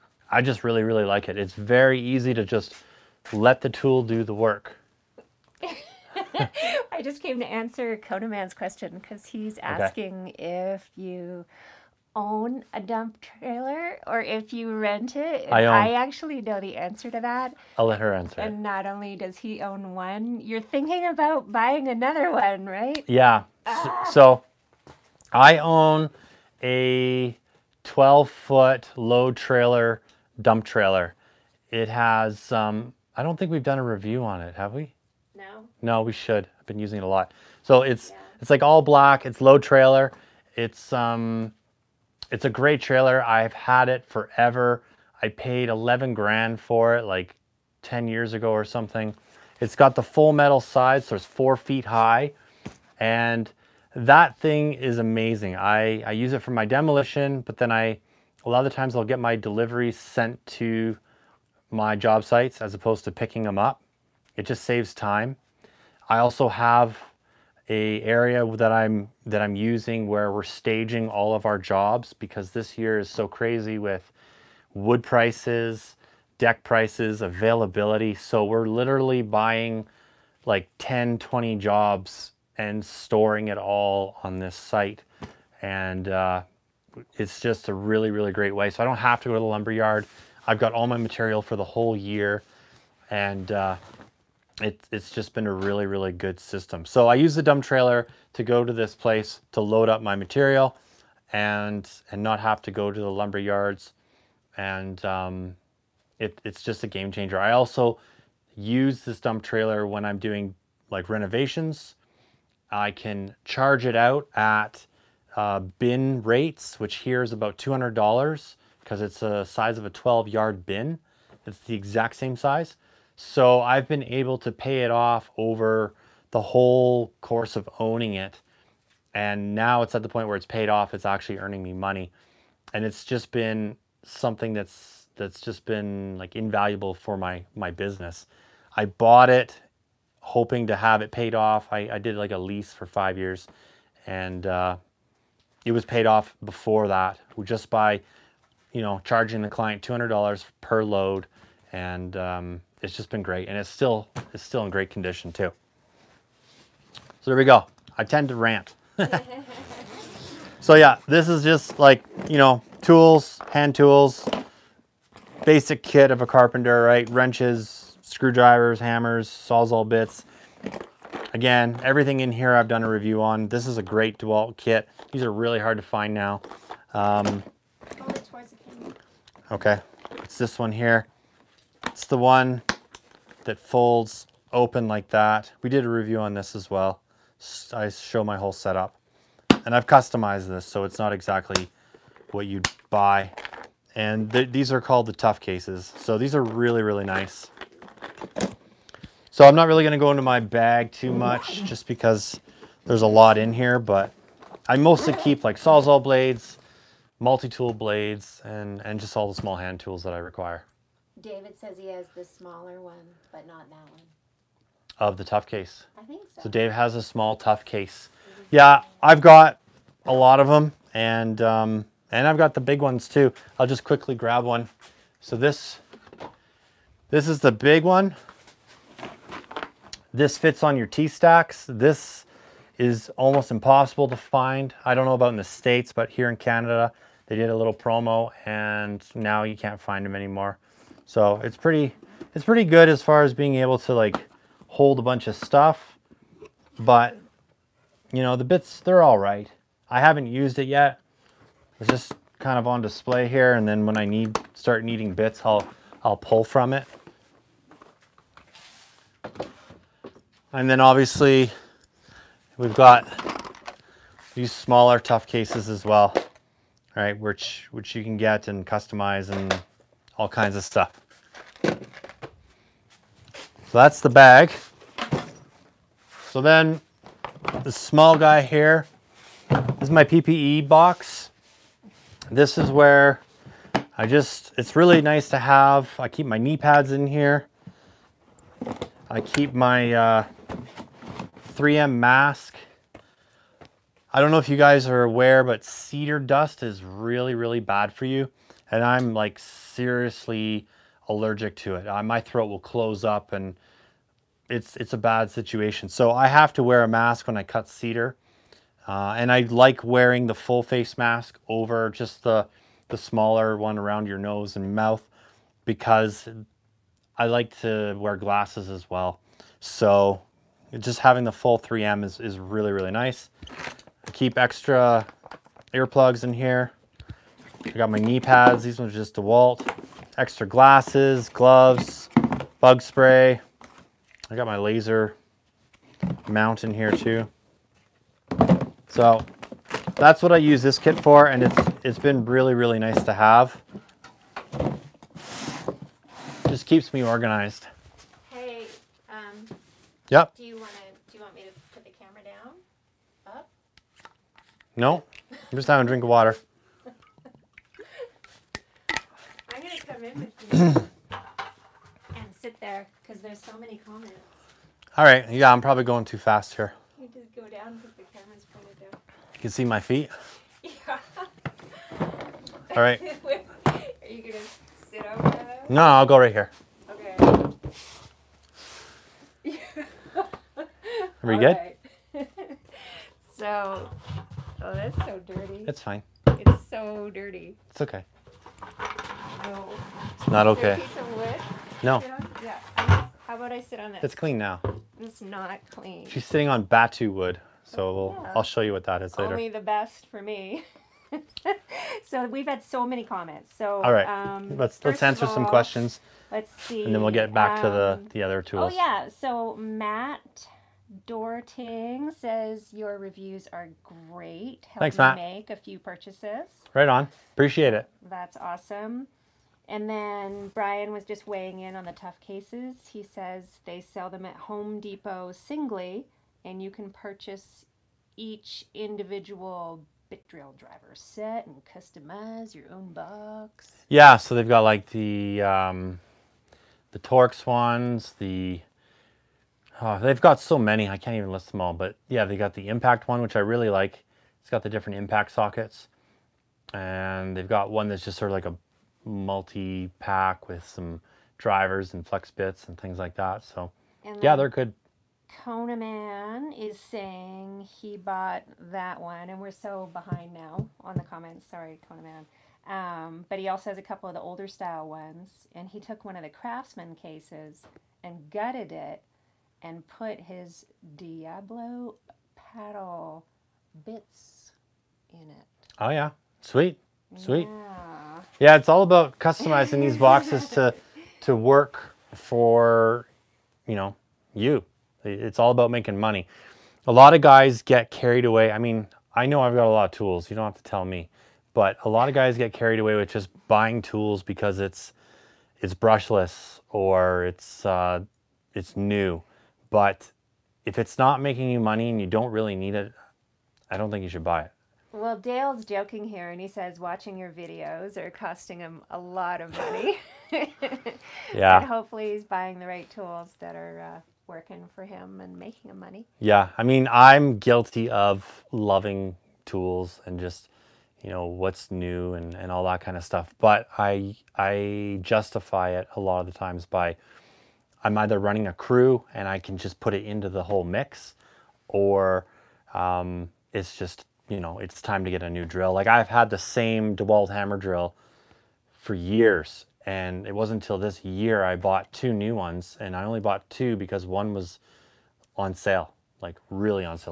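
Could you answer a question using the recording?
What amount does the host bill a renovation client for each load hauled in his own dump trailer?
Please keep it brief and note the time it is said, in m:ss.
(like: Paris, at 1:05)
$200, at 2:29.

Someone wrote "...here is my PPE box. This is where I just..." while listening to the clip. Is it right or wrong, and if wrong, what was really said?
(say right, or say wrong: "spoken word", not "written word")
right.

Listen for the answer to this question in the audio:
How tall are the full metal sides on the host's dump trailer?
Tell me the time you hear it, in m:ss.
0:51.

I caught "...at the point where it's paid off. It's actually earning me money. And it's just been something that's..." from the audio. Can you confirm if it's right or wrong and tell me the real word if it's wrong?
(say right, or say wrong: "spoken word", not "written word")
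right.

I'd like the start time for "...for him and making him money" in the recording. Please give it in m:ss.
8:34.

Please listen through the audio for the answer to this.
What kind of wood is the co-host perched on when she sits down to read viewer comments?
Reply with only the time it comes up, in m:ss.
6:36.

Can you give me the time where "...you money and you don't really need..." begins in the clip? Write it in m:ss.
8:21.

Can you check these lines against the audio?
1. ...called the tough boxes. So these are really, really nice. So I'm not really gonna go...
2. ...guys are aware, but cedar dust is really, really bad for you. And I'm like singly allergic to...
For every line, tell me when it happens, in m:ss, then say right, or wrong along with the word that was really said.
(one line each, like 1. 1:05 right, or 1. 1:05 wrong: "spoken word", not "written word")
1. 3:14 wrong: "cases", not "boxes"
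2. 4:54 wrong: "seriously", not "singly".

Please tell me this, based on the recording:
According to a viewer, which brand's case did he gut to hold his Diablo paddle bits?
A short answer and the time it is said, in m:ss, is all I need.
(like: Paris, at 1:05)
Craftsman, at 7:46.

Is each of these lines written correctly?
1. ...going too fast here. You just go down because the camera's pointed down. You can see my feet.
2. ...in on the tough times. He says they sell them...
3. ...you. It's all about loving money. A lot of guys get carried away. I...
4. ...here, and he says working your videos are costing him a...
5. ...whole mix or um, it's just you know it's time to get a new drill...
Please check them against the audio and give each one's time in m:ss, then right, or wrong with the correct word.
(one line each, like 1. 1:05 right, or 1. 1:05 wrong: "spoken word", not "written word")
1. 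6:05 right
2. 7:01 wrong: "cases", not "times"
3. 8:04 wrong: "making", not "loving"
4. 8:26 wrong: "watching", not "working"
5. 8:50 right.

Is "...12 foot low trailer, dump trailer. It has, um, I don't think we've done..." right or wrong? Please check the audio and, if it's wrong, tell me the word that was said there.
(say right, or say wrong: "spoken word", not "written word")
right.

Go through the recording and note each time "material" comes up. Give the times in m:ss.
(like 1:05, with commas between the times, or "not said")
1:30, 1:40.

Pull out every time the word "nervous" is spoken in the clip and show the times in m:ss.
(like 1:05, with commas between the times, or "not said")
not said.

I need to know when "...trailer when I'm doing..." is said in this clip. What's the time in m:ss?
1:49.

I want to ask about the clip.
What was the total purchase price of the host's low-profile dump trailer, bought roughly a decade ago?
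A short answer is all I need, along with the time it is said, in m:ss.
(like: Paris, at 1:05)
$11,000, at 0:45.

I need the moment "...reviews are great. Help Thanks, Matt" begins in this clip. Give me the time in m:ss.
6:52.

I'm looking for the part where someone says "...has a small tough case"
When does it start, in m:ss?
3:36.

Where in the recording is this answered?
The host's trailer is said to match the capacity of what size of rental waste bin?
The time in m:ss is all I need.
1:59.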